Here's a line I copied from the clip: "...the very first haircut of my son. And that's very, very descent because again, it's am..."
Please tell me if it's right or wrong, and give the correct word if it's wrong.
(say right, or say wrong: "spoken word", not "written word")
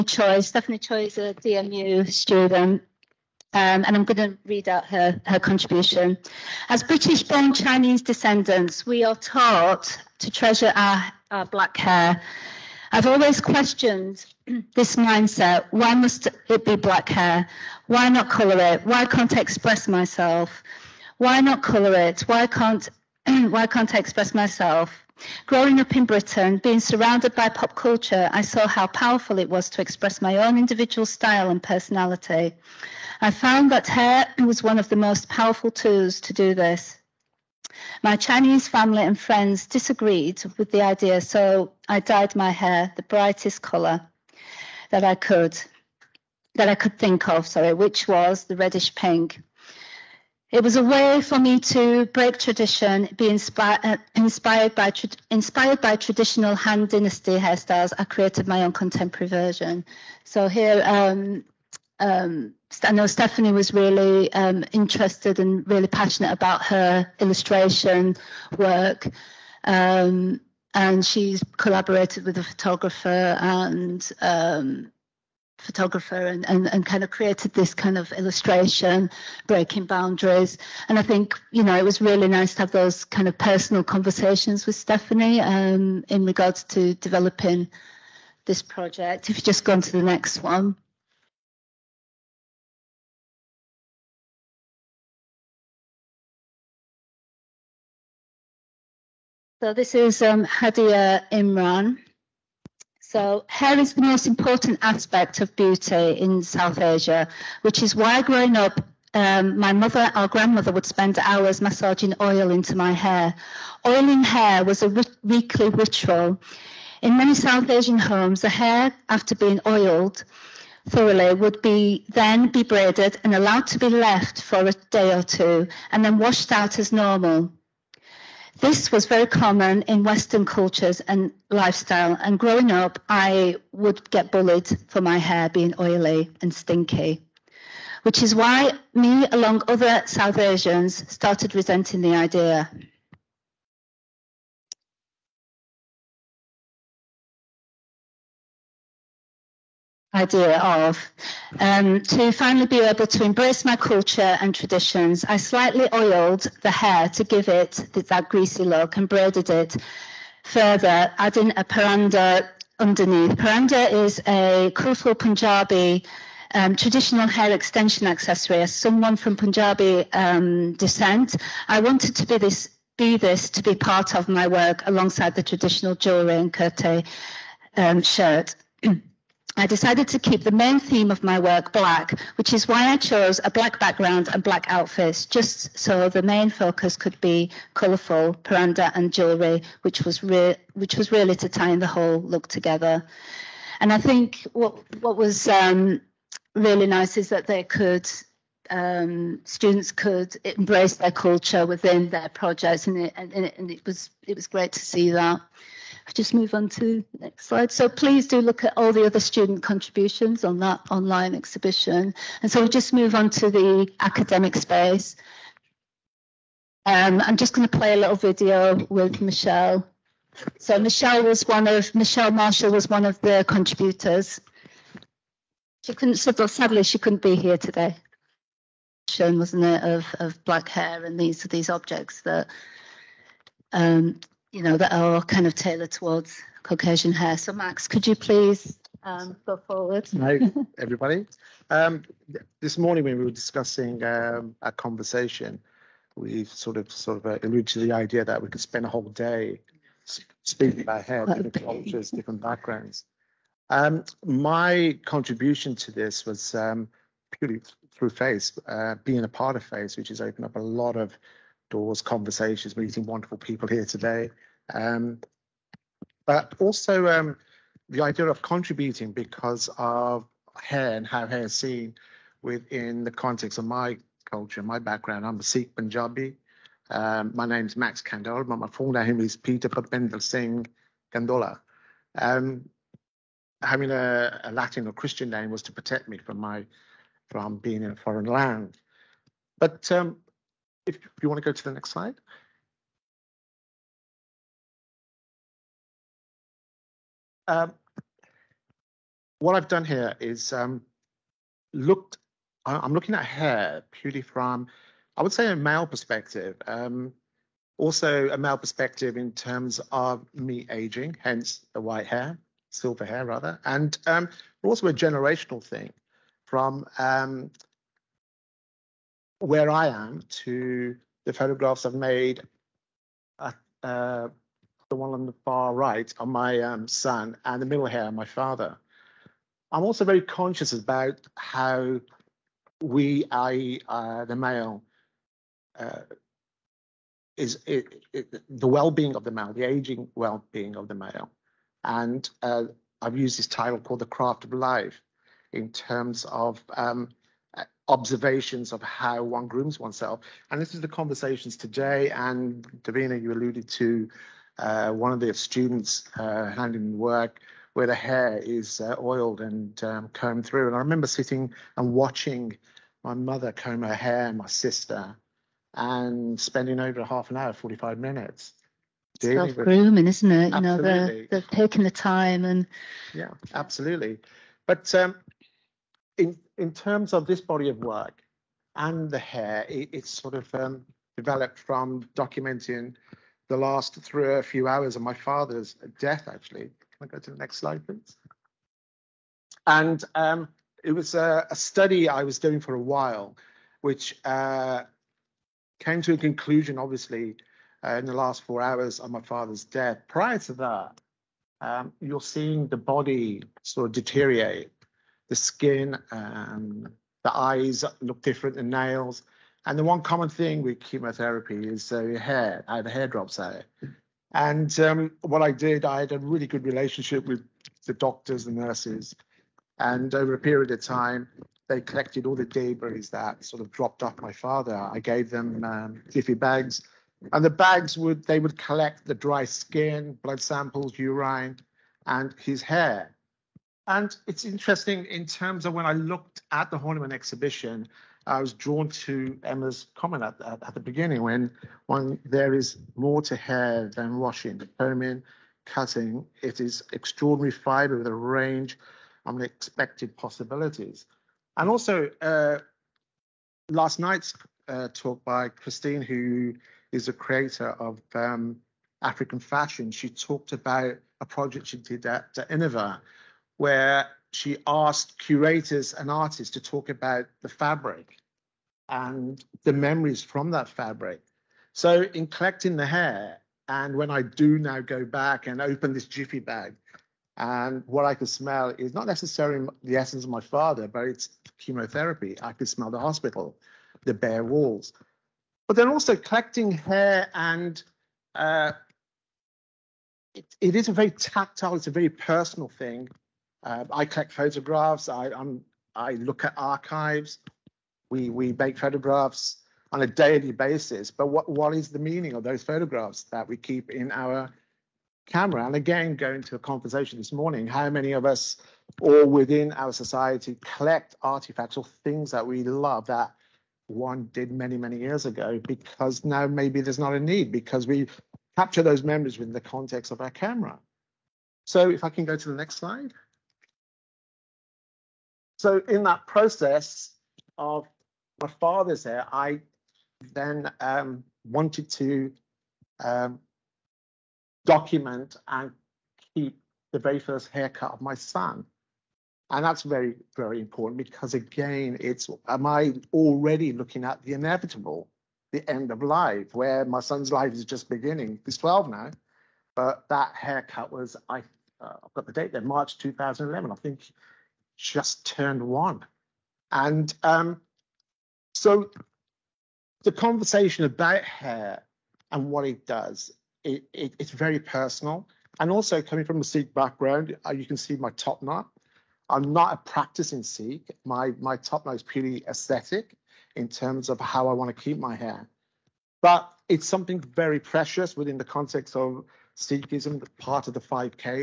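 wrong: "important", not "descent".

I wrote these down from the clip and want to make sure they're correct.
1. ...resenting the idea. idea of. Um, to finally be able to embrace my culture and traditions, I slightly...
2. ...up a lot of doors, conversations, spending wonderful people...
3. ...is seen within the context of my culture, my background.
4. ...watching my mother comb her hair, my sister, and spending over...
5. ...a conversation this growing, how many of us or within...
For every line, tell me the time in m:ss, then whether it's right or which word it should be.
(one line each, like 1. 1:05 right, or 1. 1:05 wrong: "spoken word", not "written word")
1. 2:21 right
2. 4:20 wrong: "meeting", not "spending"
3. 4:31 right
4. 6:01 right
5. 8:26 wrong: "morning", not "growing".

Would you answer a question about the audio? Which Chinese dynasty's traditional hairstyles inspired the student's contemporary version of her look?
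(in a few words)
Han Dynasty.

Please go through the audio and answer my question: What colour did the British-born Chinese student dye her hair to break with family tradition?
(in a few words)
reddish pink.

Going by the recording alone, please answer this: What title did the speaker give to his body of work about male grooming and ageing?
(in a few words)
The Craft of Life.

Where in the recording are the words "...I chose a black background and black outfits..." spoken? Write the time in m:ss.
3:02.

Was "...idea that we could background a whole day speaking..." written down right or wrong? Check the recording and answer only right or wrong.
wrong.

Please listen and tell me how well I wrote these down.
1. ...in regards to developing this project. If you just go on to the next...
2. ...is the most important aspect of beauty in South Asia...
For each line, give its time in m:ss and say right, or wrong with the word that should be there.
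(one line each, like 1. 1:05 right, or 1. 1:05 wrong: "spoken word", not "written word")
1. 1:26 right
2. 1:43 right.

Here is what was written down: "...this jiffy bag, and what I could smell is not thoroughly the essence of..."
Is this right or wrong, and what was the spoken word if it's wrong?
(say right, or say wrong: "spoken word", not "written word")
wrong: "necessarily", not "thoroughly".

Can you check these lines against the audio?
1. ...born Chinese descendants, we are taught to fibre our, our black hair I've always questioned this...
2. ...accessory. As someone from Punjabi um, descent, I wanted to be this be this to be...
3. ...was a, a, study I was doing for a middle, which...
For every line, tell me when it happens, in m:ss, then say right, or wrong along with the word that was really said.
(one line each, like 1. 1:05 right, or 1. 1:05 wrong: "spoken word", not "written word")
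1. 0:07 wrong: "treasure", not "fibre"
2. 2:48 right
3. 6:30 wrong: "while", not "middle".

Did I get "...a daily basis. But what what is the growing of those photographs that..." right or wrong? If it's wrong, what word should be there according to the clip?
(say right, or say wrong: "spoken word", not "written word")
wrong: "meaning", not "growing".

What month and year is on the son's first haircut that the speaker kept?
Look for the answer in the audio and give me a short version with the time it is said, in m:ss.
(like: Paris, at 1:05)
March 2011, at 9:12.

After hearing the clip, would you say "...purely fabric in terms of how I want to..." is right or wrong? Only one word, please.
wrong.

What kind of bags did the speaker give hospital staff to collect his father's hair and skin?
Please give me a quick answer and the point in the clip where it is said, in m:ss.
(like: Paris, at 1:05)
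jiffy bags, at 7:06.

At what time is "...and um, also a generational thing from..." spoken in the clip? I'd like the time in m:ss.
5:13.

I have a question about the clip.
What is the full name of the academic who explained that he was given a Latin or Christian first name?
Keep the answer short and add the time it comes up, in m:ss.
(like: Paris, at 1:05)
Peter Papendra Singh Kandhola, at 4:39.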